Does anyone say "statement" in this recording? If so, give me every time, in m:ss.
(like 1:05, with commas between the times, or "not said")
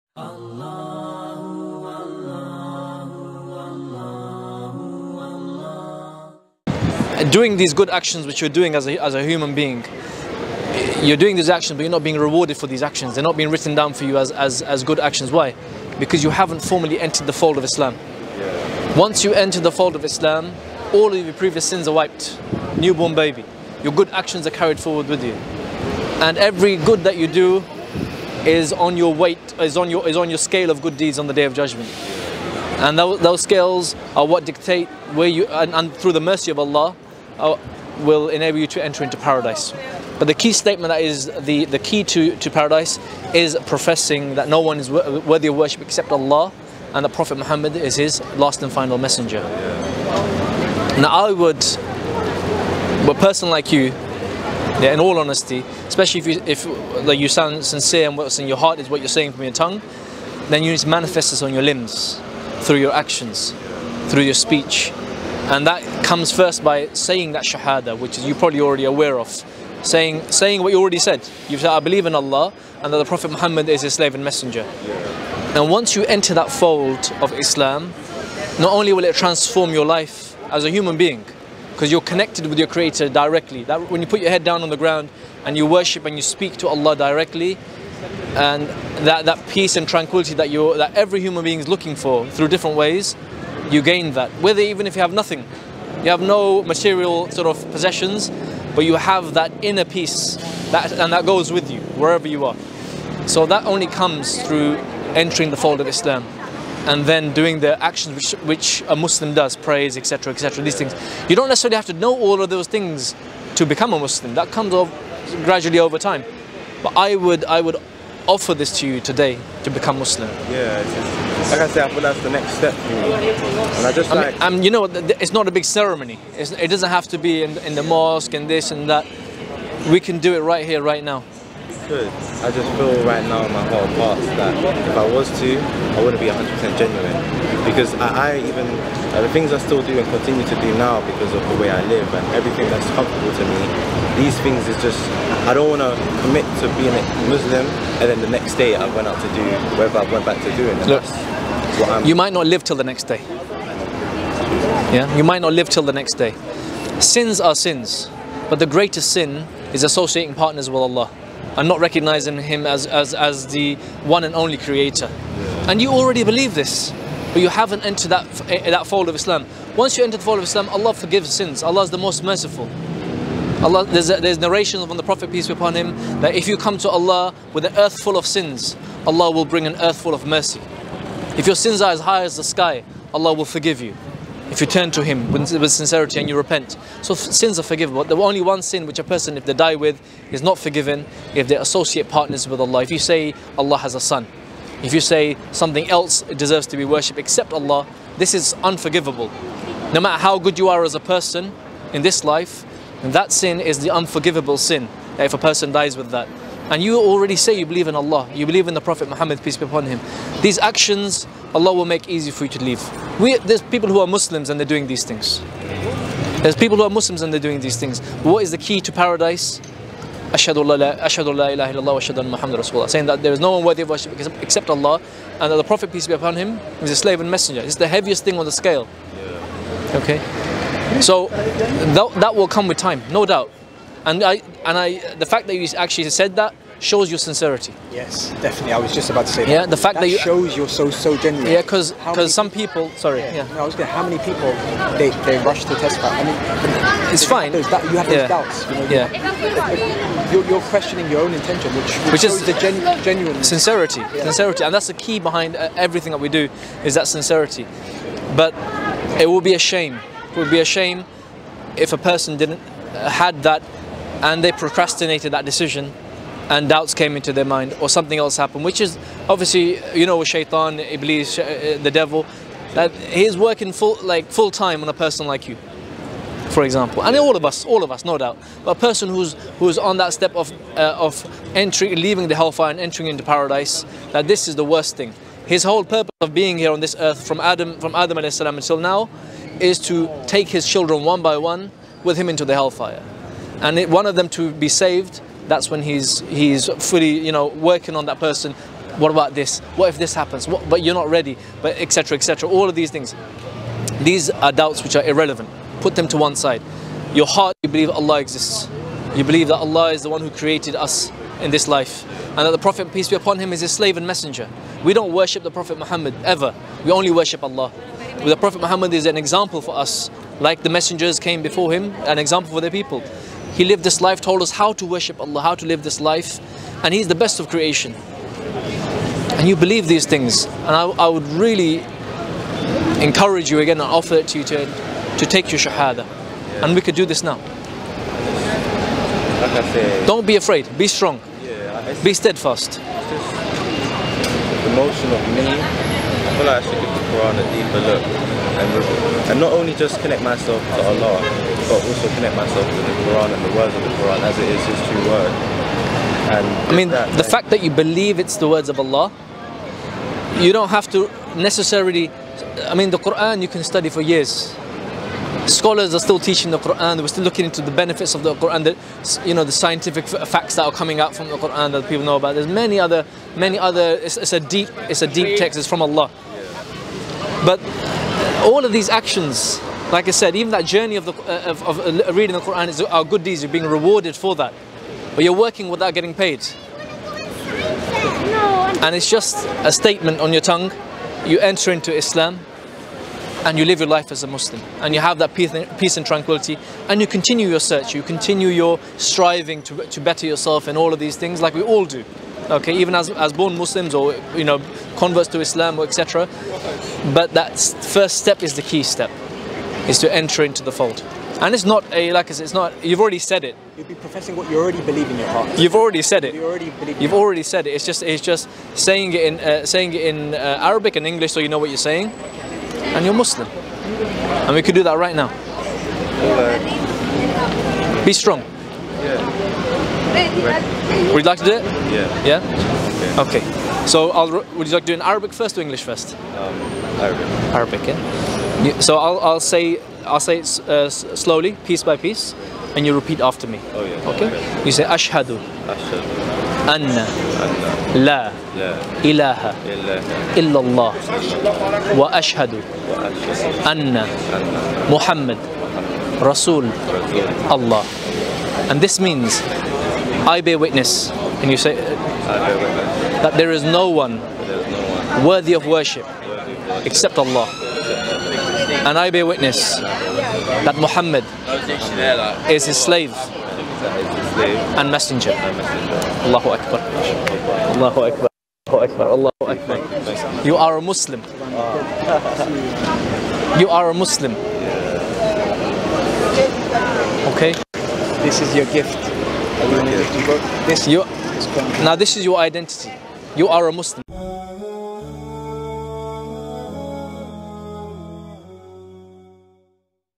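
0:40, 6:29.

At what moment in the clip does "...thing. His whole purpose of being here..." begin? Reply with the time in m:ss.
4:44.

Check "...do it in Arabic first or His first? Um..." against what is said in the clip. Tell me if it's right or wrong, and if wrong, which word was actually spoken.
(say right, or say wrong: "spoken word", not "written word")
wrong: "English", not "His".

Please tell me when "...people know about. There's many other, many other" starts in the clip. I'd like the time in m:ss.
6:11.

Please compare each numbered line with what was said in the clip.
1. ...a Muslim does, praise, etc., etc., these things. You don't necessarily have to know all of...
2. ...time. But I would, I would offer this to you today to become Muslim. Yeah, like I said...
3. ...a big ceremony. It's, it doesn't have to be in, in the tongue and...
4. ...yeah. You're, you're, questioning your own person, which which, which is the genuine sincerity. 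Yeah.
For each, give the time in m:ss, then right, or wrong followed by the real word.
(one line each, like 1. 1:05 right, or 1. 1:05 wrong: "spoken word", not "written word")
1. 1:48 right
2. 1:55 right
3. 2:05 wrong: "mosque", not "tongue"
4. 4:08 wrong: "intention", not "person".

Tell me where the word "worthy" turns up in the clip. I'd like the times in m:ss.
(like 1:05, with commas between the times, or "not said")
0:44, 3:43, 7:45.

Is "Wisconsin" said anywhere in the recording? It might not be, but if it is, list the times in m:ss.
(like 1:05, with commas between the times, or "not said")
not said.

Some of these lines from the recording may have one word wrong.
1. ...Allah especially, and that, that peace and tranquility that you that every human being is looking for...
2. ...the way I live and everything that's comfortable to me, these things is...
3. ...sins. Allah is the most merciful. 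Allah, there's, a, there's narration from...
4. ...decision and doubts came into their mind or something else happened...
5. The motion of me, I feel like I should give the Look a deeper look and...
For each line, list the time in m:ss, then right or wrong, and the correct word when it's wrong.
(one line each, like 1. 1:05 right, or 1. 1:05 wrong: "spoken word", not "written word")
1. 1:26 wrong: "directly", not "especially"
2. 2:21 right
3. 2:51 right
4. 4:25 right
5. 5:42 wrong: "Quran", not "Look".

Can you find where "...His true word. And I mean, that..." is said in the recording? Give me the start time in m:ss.
5:54.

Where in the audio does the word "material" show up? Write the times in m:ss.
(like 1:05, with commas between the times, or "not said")
1:36.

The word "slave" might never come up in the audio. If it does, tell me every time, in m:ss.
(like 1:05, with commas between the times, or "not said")
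1:13, 3:46, 5:13, 7:52.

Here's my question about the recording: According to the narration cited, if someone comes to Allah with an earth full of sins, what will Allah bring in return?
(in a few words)
an earth full of mercy.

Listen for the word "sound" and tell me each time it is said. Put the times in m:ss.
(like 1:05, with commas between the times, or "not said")
0:57.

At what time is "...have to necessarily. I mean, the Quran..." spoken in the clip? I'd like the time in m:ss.
6:00.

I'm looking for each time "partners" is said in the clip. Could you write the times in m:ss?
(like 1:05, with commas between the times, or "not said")
2:40, 3:12.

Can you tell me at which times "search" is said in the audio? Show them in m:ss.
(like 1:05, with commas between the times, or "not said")
6:37.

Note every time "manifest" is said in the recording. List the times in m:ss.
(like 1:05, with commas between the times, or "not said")
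1:00.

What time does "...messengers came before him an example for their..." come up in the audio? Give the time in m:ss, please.
5:20.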